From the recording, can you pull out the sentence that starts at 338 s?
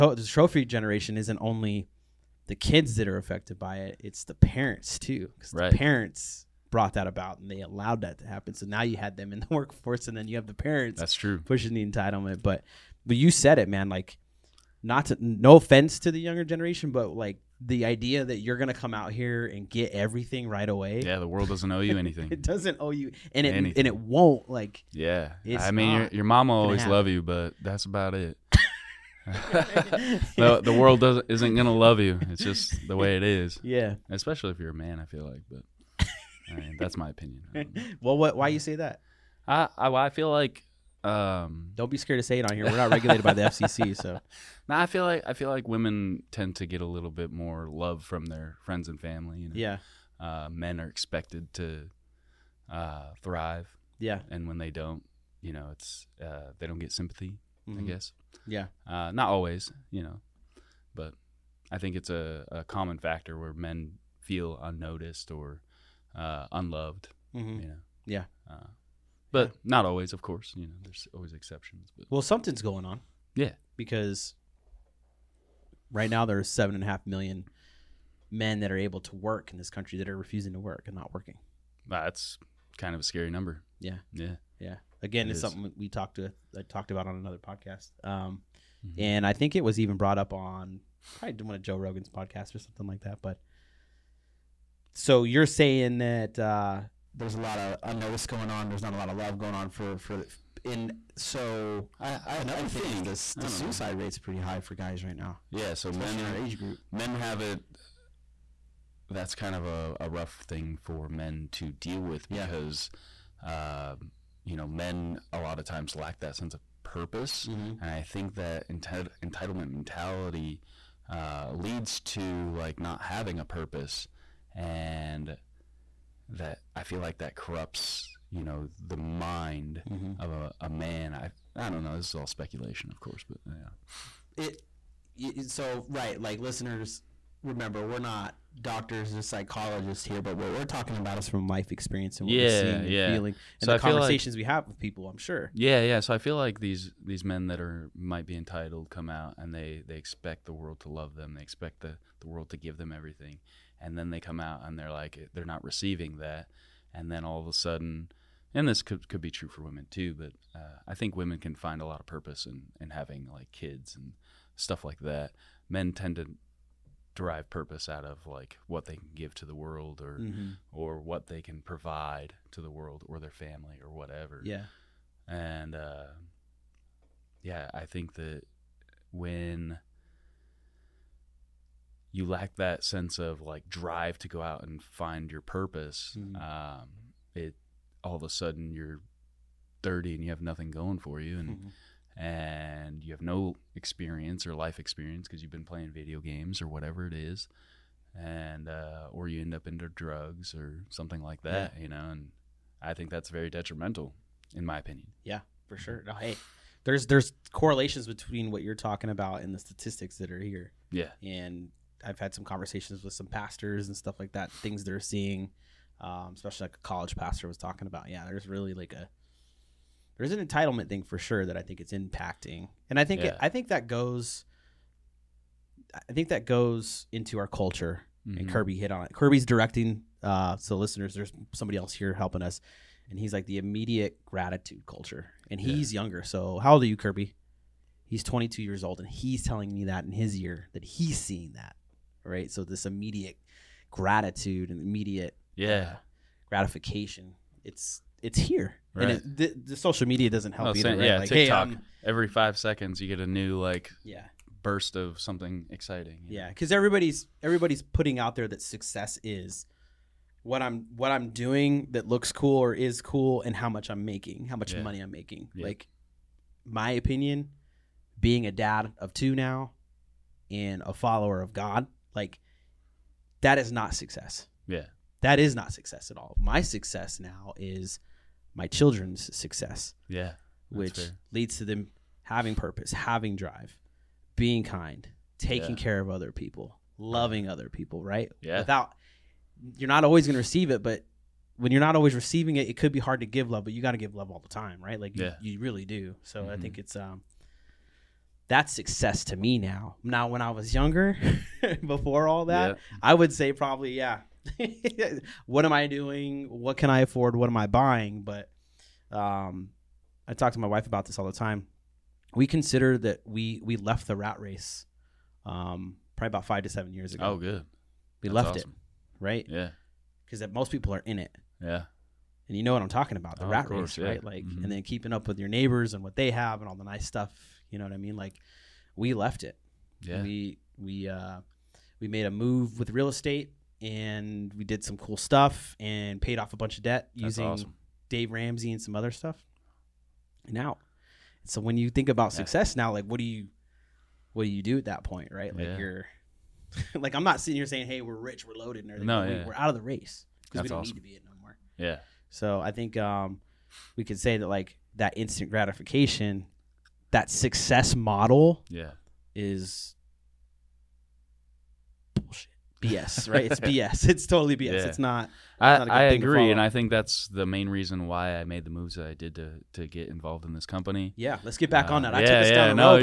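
Dave Ramsey and some other stuff.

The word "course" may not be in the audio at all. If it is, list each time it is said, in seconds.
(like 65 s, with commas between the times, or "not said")
70 s, 132 s, 323 s.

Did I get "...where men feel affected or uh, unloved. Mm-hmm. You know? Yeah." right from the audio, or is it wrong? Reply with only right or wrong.
wrong.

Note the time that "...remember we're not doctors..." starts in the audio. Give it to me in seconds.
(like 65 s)
137 s.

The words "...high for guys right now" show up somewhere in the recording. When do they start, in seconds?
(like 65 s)
104 s.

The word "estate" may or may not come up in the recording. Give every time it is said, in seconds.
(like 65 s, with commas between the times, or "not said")
333 s.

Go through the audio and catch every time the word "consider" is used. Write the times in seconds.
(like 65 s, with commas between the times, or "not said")
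312 s.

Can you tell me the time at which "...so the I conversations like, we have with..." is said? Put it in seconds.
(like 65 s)
143 s.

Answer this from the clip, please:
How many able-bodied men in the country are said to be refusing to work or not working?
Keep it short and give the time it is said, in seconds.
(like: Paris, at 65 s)
7.5 million, at 76 s.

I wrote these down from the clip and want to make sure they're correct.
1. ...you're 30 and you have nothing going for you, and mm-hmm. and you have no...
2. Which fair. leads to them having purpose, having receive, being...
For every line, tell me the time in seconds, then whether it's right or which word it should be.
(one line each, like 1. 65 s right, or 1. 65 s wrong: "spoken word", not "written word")
1. 188 s right
2. 280 s wrong: "drive", not "receive".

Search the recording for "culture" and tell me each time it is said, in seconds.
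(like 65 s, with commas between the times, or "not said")
227 s, 234 s.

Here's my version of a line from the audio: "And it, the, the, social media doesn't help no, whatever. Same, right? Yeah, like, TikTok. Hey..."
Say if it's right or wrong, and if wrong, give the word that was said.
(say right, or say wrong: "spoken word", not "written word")
wrong: "either", not "whatever".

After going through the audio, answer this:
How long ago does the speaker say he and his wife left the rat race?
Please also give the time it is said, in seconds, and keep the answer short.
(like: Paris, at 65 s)
5 to 7 years ago, at 316 s.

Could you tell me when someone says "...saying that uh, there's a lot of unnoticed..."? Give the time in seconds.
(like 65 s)
95 s.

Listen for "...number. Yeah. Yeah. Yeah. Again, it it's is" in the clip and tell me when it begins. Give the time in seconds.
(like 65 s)
83 s.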